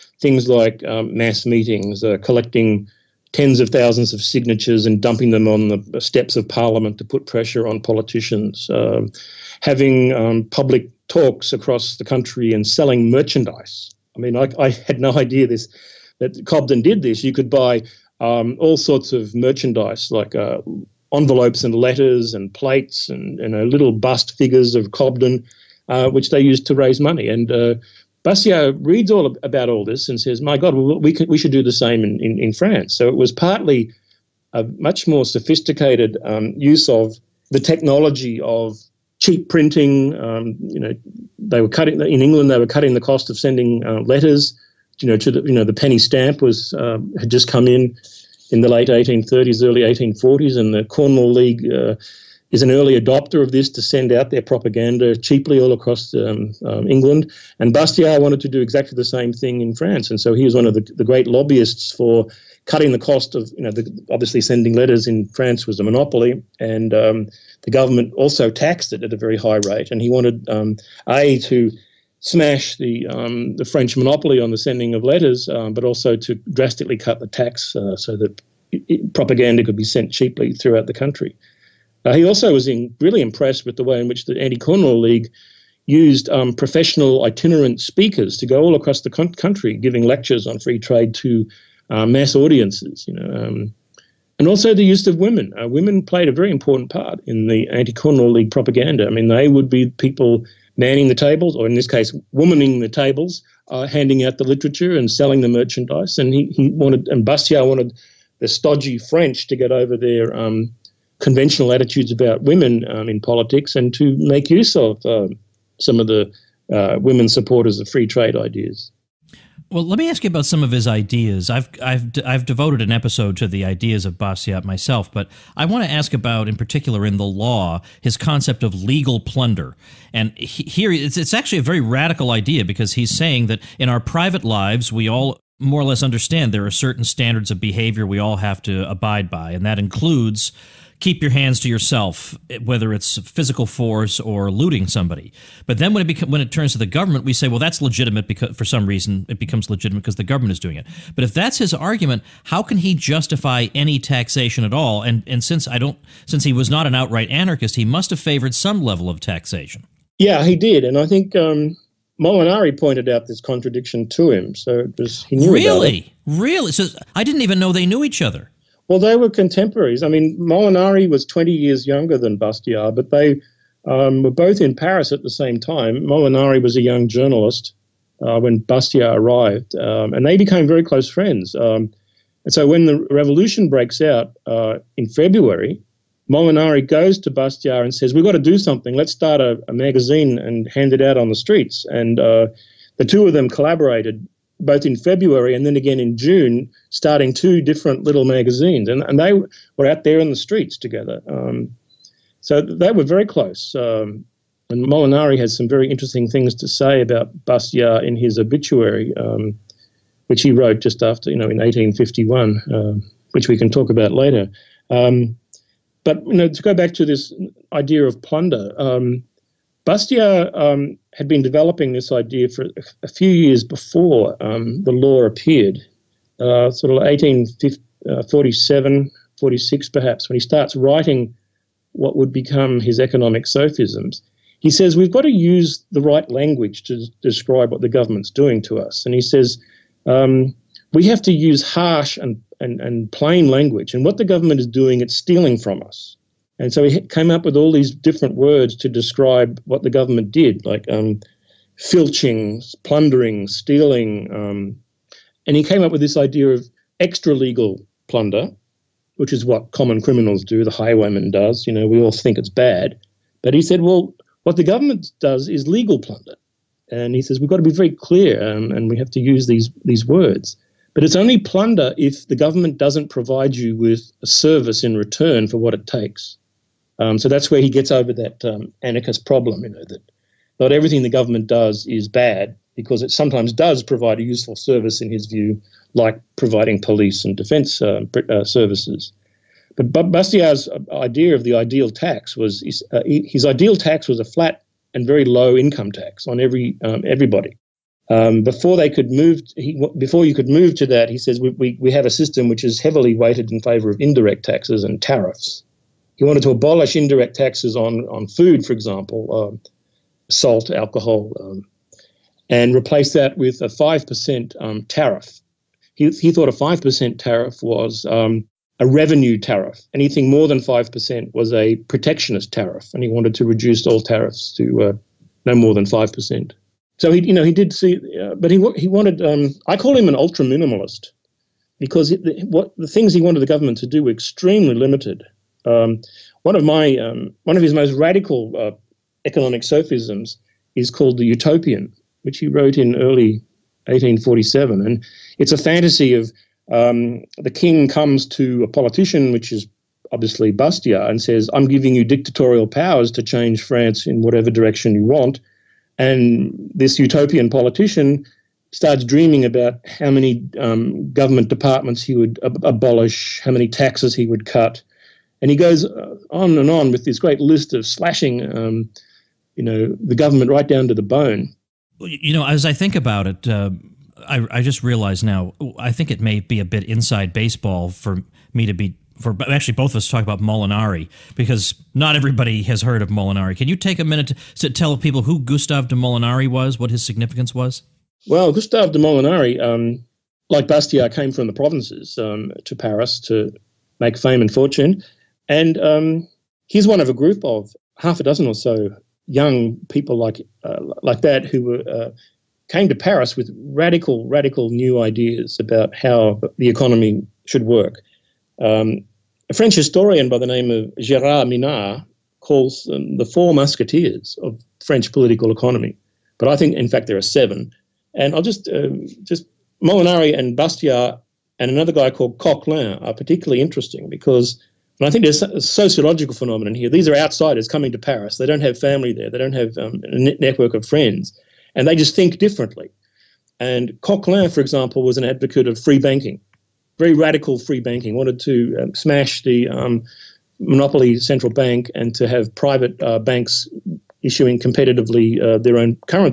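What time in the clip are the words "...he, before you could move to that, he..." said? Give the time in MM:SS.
04:59.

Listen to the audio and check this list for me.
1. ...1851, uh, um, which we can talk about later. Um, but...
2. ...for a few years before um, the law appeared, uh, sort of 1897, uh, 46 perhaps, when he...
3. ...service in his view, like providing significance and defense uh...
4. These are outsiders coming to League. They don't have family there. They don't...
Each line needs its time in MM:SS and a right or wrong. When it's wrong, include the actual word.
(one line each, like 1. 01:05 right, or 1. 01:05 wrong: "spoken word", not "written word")
1. 03:31 right
2. 03:42 wrong: "1847", not "1897"
3. 04:44 wrong: "police", not "significance"
4. 07:06 wrong: "Paris", not "League".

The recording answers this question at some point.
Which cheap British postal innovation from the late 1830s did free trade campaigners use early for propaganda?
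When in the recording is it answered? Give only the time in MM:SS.
00:45.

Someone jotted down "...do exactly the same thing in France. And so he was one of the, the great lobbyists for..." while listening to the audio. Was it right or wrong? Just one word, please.
right.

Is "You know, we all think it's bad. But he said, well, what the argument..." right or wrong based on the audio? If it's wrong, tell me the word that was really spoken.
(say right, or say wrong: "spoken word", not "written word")
wrong: "government", not "argument".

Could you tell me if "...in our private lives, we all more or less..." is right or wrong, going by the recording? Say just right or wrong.
right.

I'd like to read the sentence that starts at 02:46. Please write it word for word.
So I didn't even know they knew each other.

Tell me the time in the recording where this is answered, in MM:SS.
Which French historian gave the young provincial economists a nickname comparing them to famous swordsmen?
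06:50.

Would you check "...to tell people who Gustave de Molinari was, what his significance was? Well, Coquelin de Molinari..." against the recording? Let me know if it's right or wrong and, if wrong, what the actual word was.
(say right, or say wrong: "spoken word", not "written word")
wrong: "Gustave", not "Coquelin".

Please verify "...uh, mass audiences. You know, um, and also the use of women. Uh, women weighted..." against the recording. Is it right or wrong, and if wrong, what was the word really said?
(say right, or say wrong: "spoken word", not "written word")
wrong: "played", not "weighted".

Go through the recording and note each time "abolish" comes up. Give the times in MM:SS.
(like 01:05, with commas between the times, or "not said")
05:06, 06:02.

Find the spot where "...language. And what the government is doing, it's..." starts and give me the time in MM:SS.
04:03.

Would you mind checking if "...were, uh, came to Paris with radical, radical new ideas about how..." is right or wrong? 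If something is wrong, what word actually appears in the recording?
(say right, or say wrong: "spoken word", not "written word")
right.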